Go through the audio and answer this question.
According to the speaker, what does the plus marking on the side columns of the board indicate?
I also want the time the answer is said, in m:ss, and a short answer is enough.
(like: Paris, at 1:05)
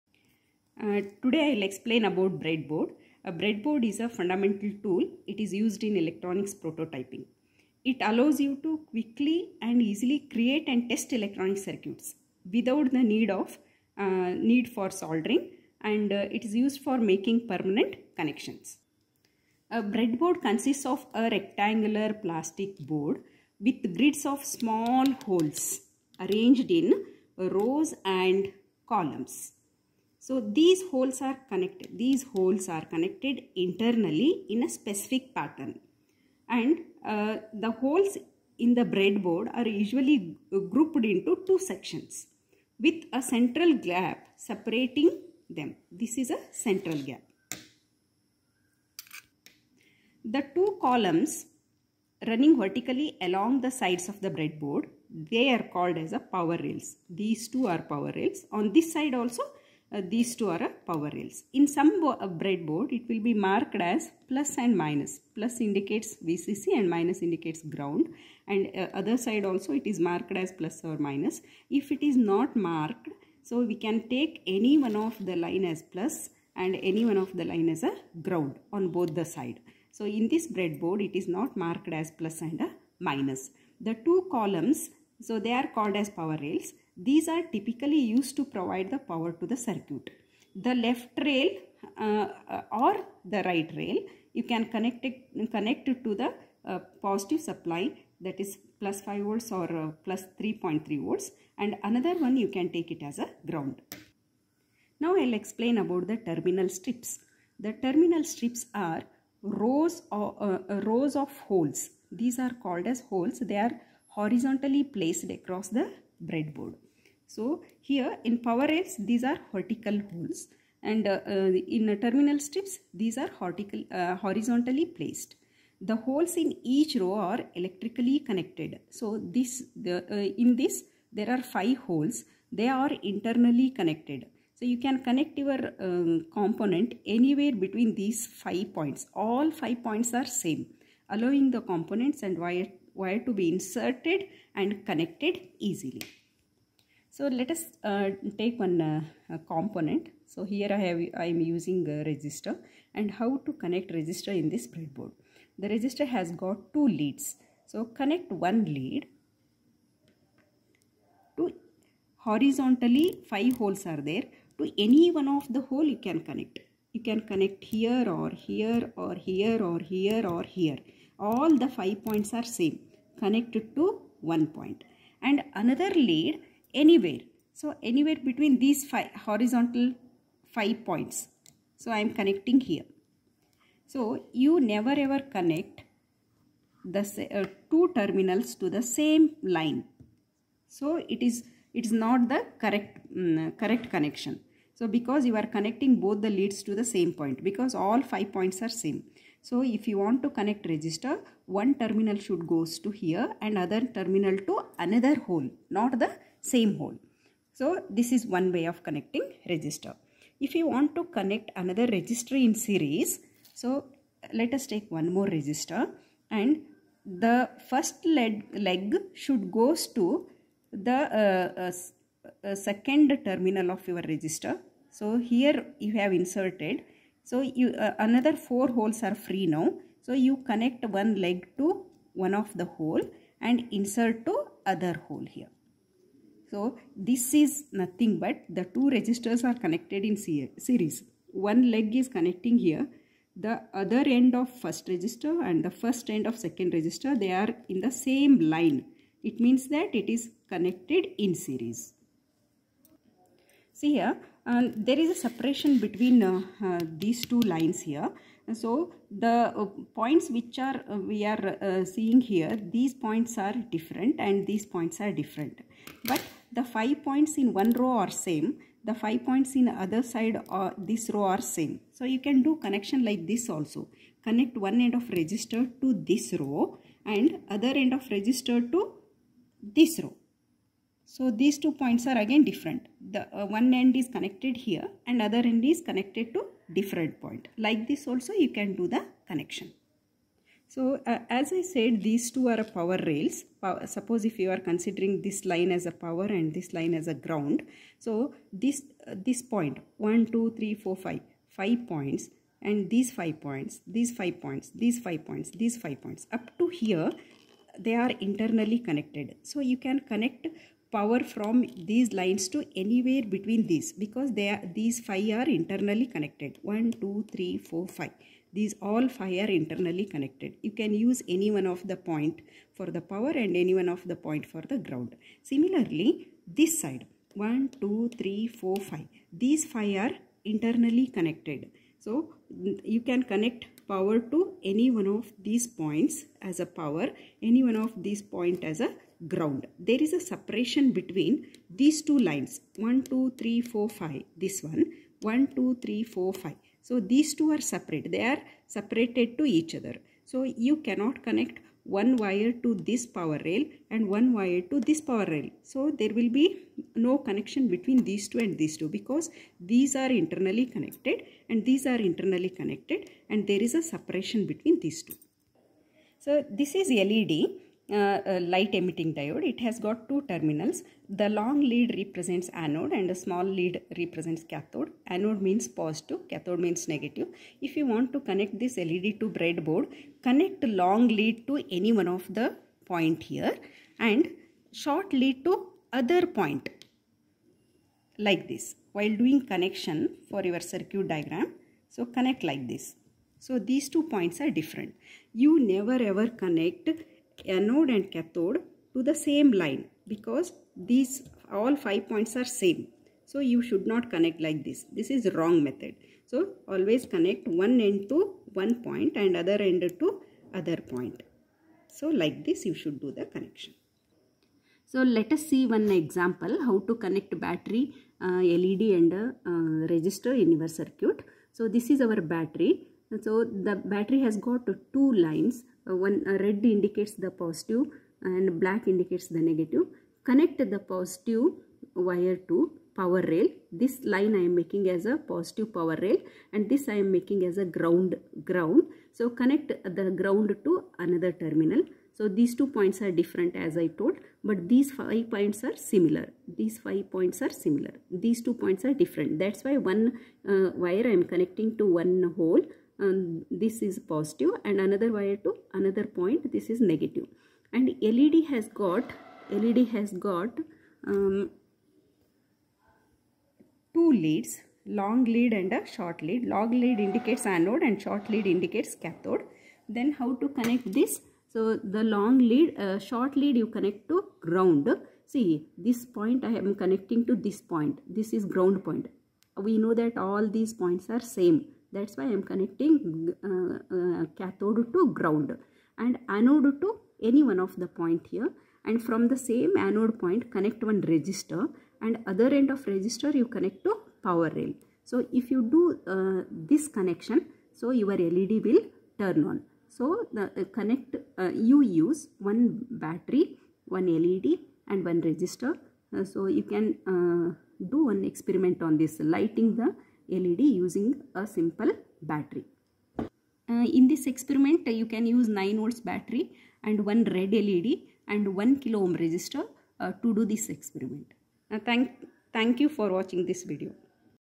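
VCC, at 1:06.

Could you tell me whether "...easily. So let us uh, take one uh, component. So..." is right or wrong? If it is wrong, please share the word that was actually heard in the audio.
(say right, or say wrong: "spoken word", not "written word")
right.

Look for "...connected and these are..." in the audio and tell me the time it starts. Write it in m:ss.
6:00.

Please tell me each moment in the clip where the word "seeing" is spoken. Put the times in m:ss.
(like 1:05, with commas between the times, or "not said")
4:21.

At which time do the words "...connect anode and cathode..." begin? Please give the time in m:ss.
6:36.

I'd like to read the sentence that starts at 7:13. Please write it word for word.
This line I am making as a positive power rail and this I am making as a ground ground.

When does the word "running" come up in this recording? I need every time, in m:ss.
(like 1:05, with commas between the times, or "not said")
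0:52.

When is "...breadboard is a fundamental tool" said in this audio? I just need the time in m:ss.
0:03.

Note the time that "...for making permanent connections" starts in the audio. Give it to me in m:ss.
0:16.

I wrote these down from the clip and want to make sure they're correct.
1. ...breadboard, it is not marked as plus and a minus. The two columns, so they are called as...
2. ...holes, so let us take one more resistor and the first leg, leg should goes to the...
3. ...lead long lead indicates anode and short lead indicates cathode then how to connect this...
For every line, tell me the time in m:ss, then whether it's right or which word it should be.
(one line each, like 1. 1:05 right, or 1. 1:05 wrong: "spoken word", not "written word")
1. 1:20 right
2. 3:32 wrong: "series", not "holes"
3. 7:46 right.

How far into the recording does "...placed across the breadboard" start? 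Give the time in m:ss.
1:54.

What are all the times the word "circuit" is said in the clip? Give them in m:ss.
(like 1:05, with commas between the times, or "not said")
0:11, 1:29, 6:30, 7:00.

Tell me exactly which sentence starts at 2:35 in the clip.
The resistor has got two leads.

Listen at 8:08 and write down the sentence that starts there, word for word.
And from the same anode point, connect one resistor and other end of resistor you connect to power rail.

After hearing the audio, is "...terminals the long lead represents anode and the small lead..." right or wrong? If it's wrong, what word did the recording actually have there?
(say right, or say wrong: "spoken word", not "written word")
right.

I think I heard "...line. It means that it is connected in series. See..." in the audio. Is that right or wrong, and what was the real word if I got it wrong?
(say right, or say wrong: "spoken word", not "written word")
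right.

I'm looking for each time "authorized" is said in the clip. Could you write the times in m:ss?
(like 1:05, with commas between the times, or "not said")
not said.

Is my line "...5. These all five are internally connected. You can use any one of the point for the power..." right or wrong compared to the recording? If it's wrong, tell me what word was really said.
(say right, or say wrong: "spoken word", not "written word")
right.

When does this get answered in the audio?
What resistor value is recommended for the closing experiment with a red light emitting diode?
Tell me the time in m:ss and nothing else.
8:38.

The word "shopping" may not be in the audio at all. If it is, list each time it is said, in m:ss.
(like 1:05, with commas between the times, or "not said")
not said.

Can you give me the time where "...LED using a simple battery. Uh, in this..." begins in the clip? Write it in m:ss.
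8:30.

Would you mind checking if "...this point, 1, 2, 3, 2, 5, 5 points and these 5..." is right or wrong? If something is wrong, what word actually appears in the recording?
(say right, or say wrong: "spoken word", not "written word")
wrong: "4", not "2".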